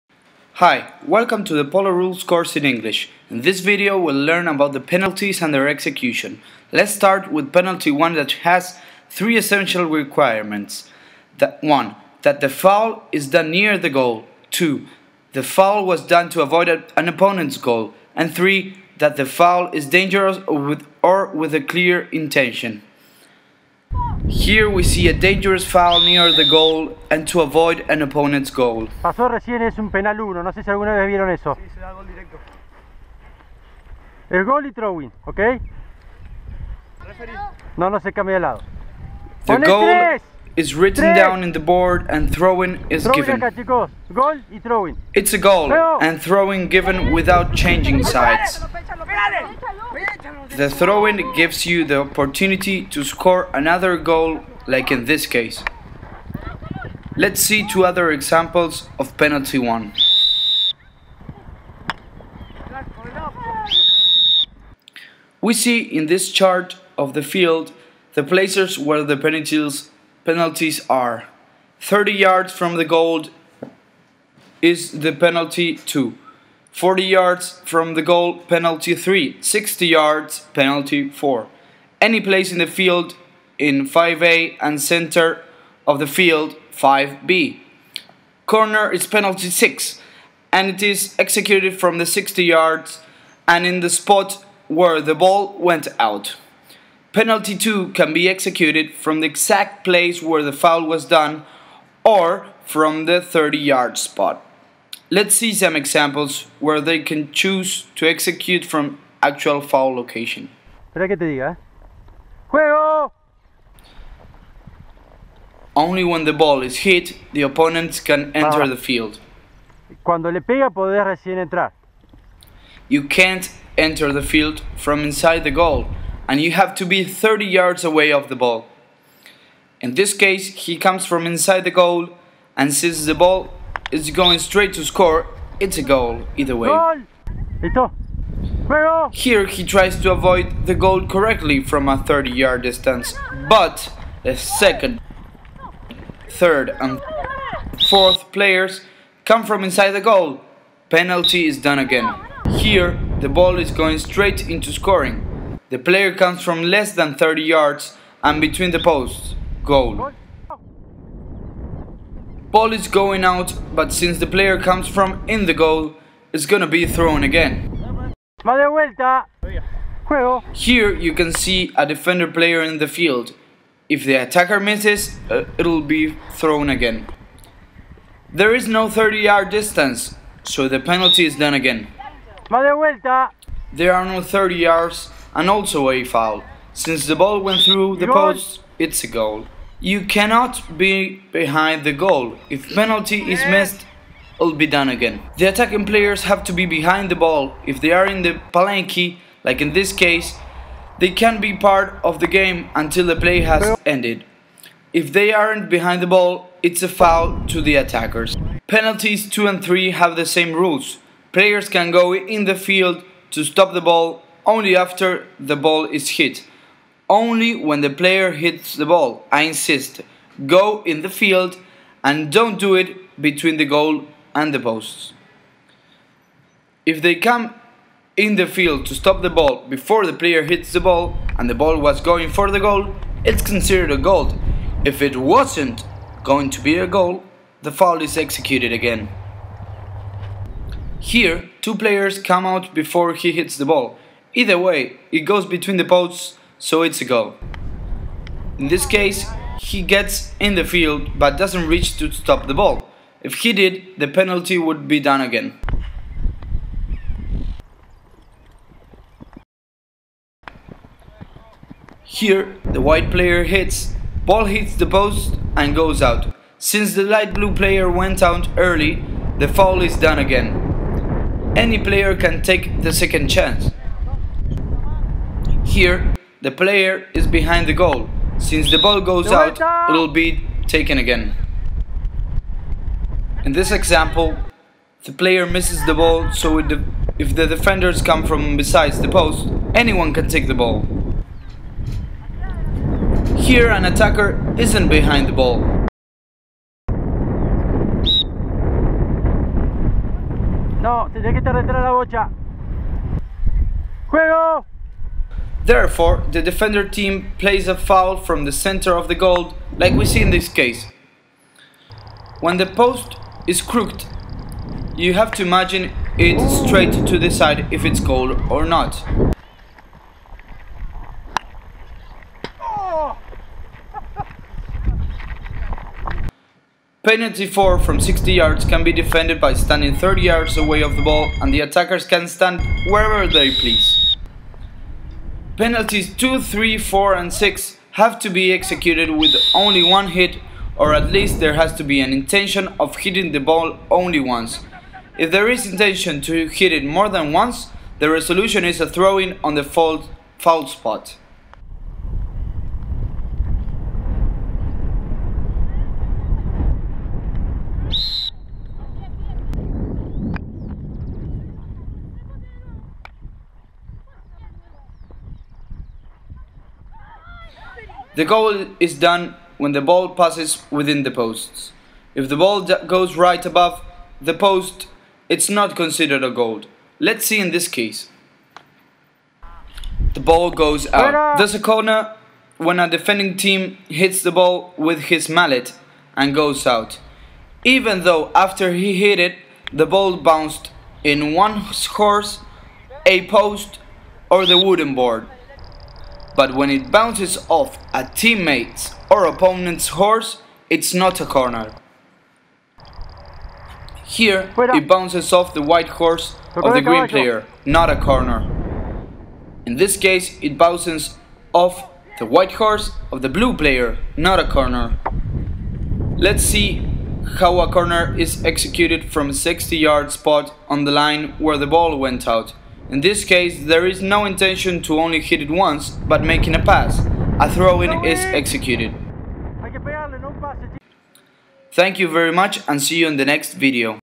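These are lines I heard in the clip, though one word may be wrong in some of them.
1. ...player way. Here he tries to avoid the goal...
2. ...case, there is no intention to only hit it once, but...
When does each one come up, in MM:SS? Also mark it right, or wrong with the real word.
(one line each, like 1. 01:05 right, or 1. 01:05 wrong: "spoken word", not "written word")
1. 02:16 wrong: "either", not "player"
2. 07:03 right.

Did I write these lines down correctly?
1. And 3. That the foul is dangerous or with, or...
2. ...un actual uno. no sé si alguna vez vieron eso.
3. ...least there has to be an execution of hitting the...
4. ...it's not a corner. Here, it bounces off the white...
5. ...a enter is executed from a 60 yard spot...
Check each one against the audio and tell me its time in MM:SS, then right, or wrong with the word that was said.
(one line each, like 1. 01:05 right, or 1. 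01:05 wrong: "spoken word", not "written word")
1. 00:18 right
2. 00:29 wrong: "penal", not "actual"
3. 05:41 wrong: "intention", not "execution"
4. 06:40 right
5. 06:57 wrong: "corner", not "enter".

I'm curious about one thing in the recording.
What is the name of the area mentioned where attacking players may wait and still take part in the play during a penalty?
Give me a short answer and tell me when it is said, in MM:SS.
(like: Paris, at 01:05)
palenque, at 03:18.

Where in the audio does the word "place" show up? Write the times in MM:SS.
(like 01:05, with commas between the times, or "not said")
01:08, 01:22, 01:39.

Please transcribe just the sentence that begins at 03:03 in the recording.
There are no 30 yards and also a foul.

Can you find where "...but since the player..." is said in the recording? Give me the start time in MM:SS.
02:43.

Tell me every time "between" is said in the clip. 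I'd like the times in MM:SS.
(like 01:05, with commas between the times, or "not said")
02:38, 03:43, 04:05.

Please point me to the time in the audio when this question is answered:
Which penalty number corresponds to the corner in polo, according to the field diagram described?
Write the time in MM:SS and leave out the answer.
01:28.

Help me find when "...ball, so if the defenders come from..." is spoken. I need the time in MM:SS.
04:45.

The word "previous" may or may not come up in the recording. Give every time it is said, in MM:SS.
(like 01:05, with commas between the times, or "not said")
not said.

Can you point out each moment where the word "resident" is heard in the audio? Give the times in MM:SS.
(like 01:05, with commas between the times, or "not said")
not said.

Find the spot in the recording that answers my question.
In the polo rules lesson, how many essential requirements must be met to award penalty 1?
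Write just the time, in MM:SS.
00:09.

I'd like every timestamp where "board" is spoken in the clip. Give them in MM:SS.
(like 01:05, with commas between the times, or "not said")
00:41, 06:34.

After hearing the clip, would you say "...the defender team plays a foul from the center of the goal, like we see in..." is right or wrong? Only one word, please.
right.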